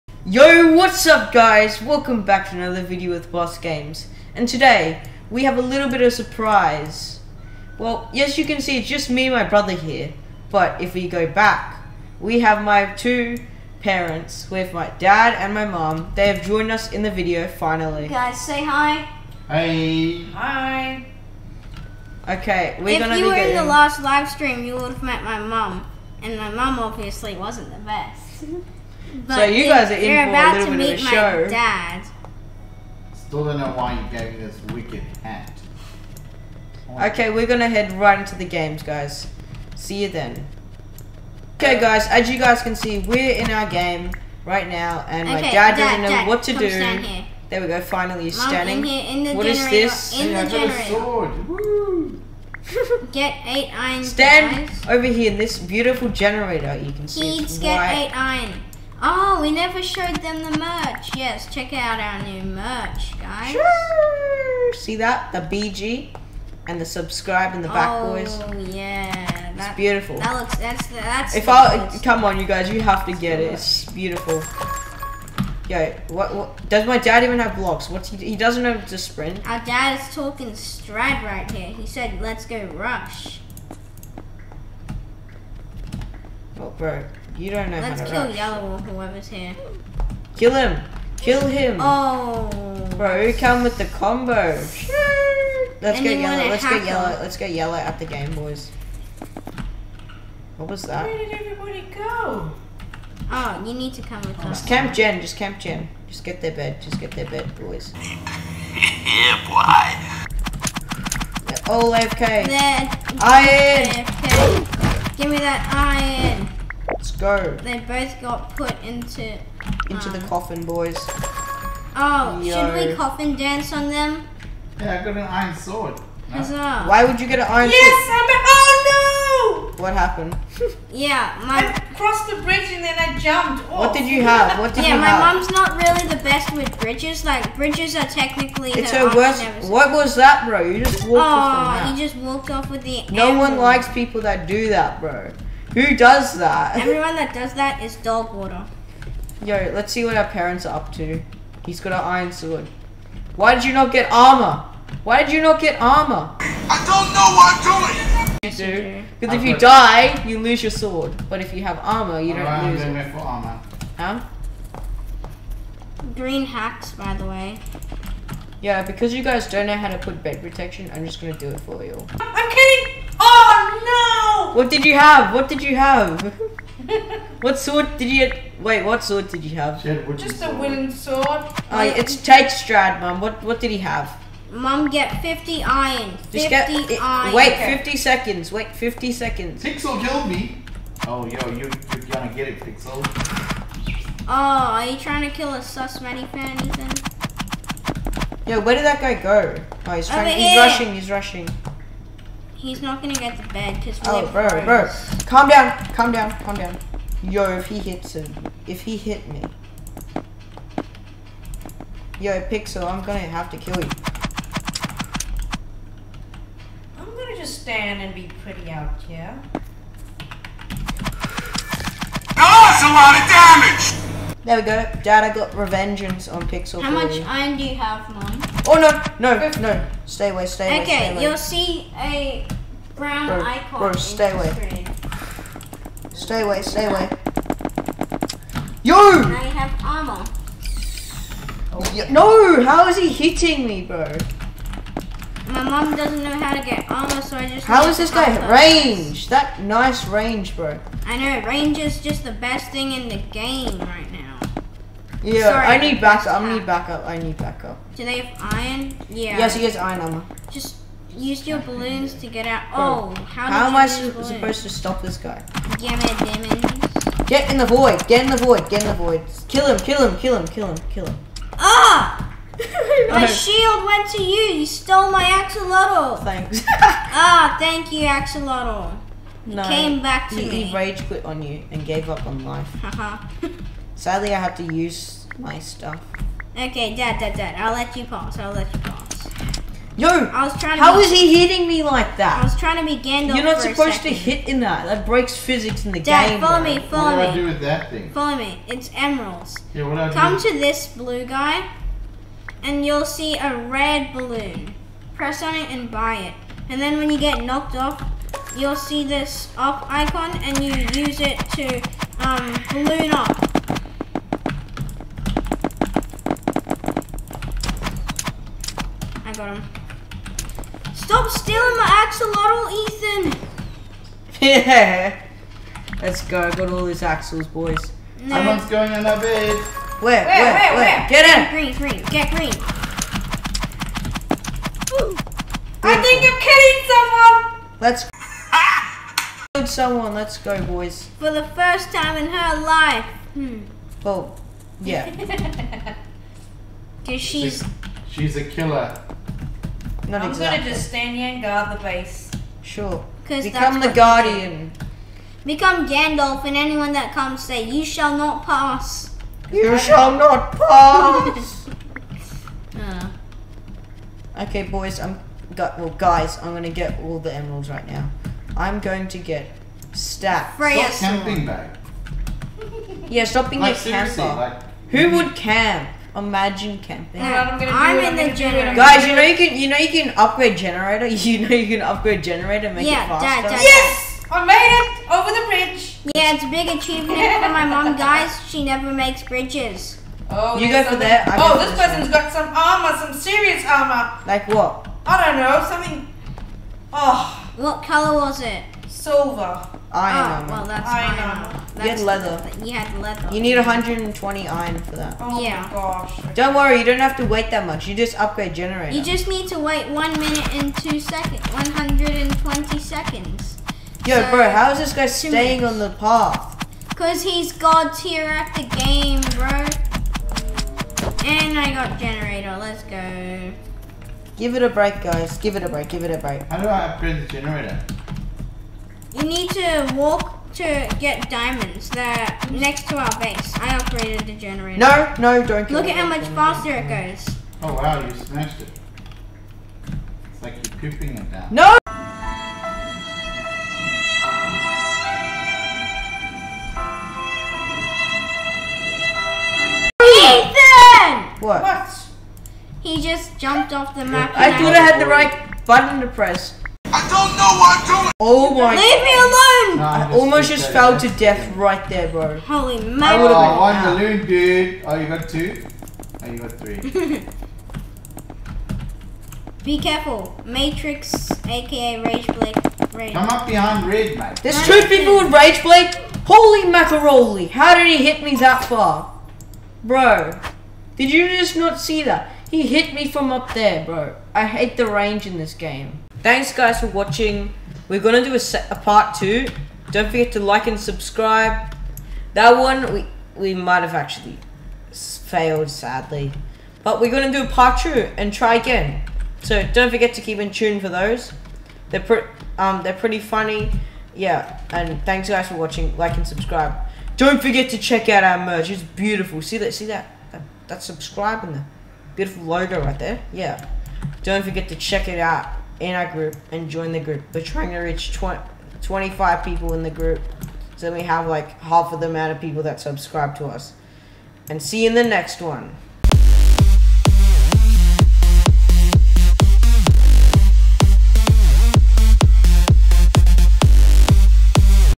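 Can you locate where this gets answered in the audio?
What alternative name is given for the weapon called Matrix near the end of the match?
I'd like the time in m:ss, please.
7:52.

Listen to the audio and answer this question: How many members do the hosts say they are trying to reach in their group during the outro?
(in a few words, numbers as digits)
25.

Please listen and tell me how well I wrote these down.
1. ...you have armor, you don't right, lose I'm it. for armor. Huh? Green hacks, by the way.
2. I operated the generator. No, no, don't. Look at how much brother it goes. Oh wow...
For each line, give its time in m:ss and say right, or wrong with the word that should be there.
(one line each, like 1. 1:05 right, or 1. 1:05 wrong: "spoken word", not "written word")
1. 2:41 right
2. 7:13 wrong: "faster", not "brother".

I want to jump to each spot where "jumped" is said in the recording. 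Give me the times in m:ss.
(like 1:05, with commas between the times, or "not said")
2:13, 7:33.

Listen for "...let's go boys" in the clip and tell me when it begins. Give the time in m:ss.
5:40.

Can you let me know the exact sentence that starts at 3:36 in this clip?
I'm gonna just stand and be pretty out here.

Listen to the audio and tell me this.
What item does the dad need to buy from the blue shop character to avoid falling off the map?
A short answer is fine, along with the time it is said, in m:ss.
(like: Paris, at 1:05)
Red balloon, at 5:03.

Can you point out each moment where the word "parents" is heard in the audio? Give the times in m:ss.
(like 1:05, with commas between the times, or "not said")
0:13, 2:30.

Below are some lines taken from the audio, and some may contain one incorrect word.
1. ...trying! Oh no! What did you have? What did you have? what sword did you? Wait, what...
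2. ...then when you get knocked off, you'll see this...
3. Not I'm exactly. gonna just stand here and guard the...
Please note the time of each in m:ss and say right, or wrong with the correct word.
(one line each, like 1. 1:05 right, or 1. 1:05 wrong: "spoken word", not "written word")
1. 2:52 wrong: "kidding", not "trying"
2. 5:06 right
3. 5:50 right.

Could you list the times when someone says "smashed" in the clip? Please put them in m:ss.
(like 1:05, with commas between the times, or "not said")
7:18.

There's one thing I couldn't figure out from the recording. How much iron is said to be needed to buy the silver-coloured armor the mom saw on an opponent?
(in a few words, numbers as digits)
120.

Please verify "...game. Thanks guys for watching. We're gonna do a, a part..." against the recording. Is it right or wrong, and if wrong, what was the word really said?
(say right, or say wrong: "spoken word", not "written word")
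right.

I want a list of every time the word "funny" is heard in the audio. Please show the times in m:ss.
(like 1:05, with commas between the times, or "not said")
8:23.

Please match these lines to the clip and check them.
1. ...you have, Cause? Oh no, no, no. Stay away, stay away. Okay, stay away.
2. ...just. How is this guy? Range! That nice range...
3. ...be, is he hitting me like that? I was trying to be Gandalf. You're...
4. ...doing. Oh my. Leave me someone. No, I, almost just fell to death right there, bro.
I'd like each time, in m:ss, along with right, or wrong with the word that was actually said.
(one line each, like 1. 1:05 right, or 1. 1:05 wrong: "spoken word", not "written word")
1. 3:47 wrong: "Mom", not "Cause"
2. 4:07 right
3. 4:50 right
4. 7:37 wrong: "alone", not "someone".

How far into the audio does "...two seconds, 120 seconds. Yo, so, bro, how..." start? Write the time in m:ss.
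6:50.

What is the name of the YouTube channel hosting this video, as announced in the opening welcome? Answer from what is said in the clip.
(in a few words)
Boss Games.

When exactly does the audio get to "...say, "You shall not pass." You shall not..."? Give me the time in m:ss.
5:57.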